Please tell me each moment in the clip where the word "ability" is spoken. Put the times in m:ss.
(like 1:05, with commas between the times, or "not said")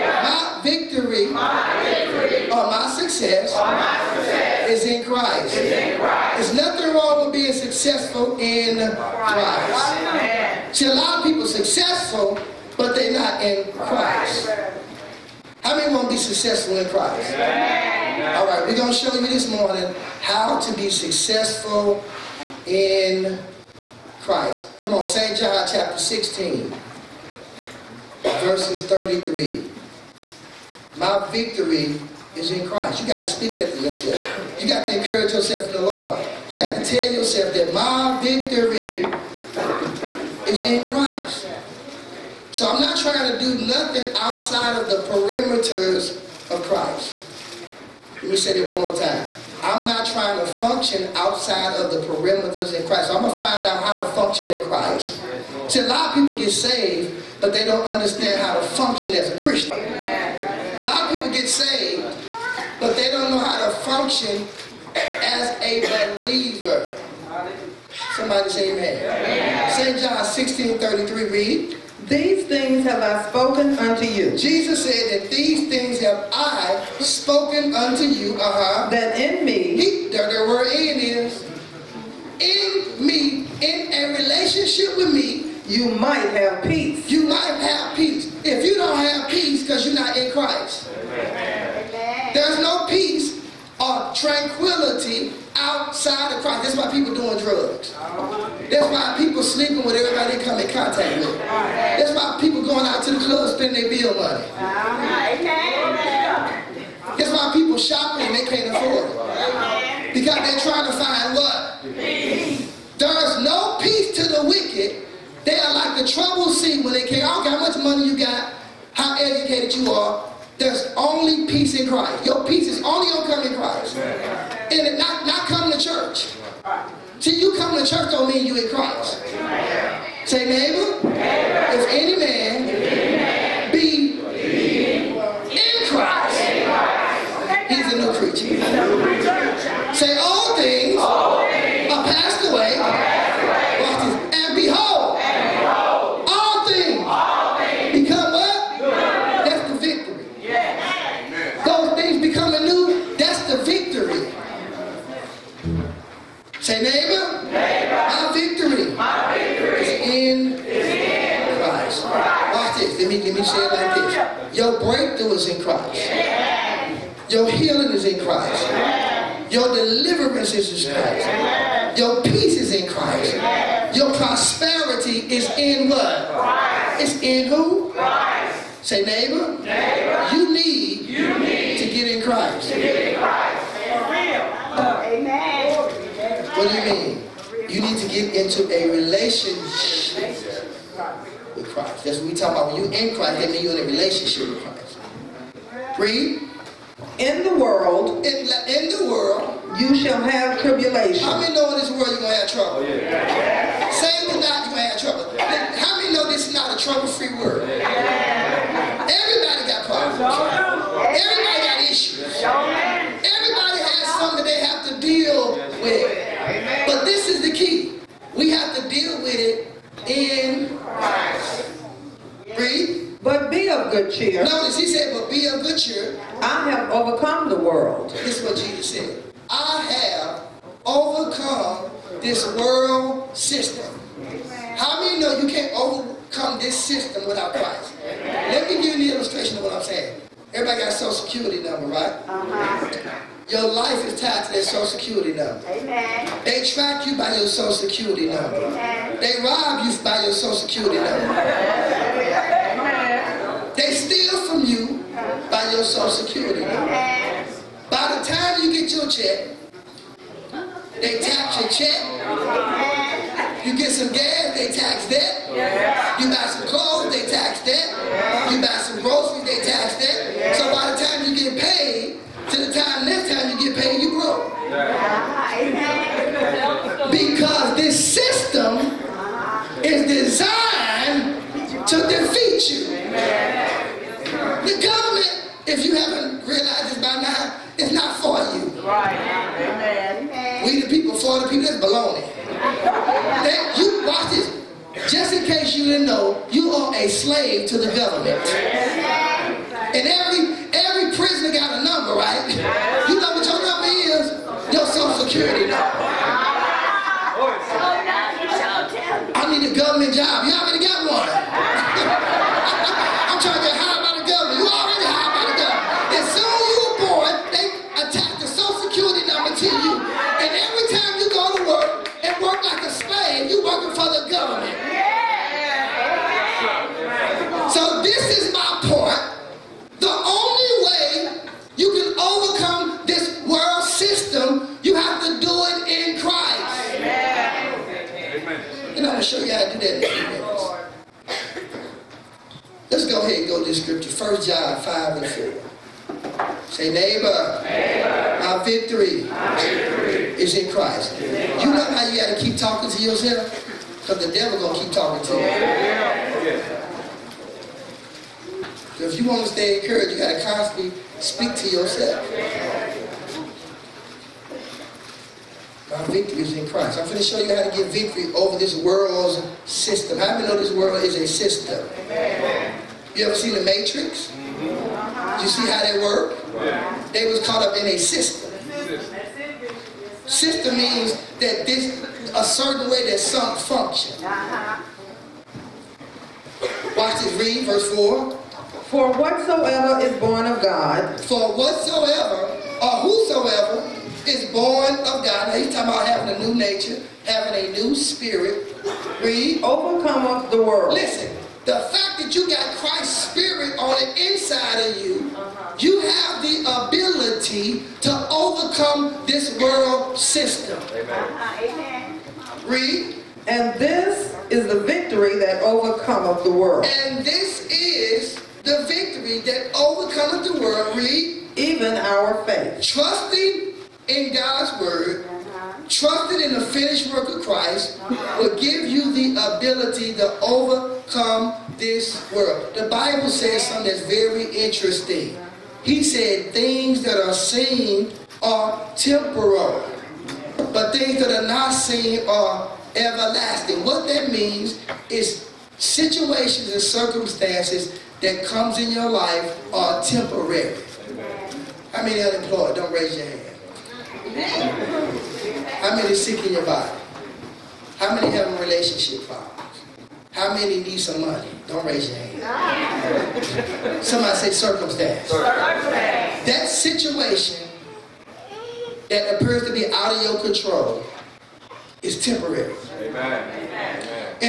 6:46, 7:09.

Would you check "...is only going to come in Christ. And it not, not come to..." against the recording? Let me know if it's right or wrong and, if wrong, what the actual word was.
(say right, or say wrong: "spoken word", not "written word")
right.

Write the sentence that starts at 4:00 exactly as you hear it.
Everybody got a social security number, right?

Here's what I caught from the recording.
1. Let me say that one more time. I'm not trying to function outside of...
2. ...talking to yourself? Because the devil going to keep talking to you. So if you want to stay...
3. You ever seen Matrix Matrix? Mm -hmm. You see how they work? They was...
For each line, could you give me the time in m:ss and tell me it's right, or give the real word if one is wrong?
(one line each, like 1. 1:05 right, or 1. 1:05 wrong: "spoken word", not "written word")
1. 0:48 right
2. 5:52 right
3. 6:13 wrong: "The", not "Matrix".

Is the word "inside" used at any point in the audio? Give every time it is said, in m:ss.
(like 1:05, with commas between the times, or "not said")
6:44.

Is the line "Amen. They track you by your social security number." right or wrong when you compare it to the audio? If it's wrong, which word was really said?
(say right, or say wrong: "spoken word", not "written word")
right.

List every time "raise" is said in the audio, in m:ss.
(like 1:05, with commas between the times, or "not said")
7:32, 7:41.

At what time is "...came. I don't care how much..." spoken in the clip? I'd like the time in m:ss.
1:57.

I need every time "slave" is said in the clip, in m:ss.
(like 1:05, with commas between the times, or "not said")
4:57.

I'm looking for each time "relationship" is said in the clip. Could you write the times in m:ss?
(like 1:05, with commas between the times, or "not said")
1:24, 3:08, 3:13, 7:38.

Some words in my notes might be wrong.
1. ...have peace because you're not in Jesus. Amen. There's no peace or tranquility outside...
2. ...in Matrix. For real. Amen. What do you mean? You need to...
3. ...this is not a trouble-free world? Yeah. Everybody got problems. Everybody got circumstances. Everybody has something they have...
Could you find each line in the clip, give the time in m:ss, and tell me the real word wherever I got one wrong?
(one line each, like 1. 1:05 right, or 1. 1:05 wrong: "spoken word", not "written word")
1. 1:28 wrong: "Christ", not "Jesus"
2. 3:03 wrong: "Christ", not "Matrix"
3. 3:26 wrong: "issues", not "circumstances".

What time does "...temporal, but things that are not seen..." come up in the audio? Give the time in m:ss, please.
7:18.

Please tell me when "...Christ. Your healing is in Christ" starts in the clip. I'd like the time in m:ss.
2:45.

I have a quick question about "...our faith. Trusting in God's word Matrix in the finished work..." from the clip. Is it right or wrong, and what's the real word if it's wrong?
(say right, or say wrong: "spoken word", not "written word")
wrong: "Trusted", not "Matrix".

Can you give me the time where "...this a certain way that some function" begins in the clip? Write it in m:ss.
6:21.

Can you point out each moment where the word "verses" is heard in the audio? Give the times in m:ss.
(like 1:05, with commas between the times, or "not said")
0:28, 6:27.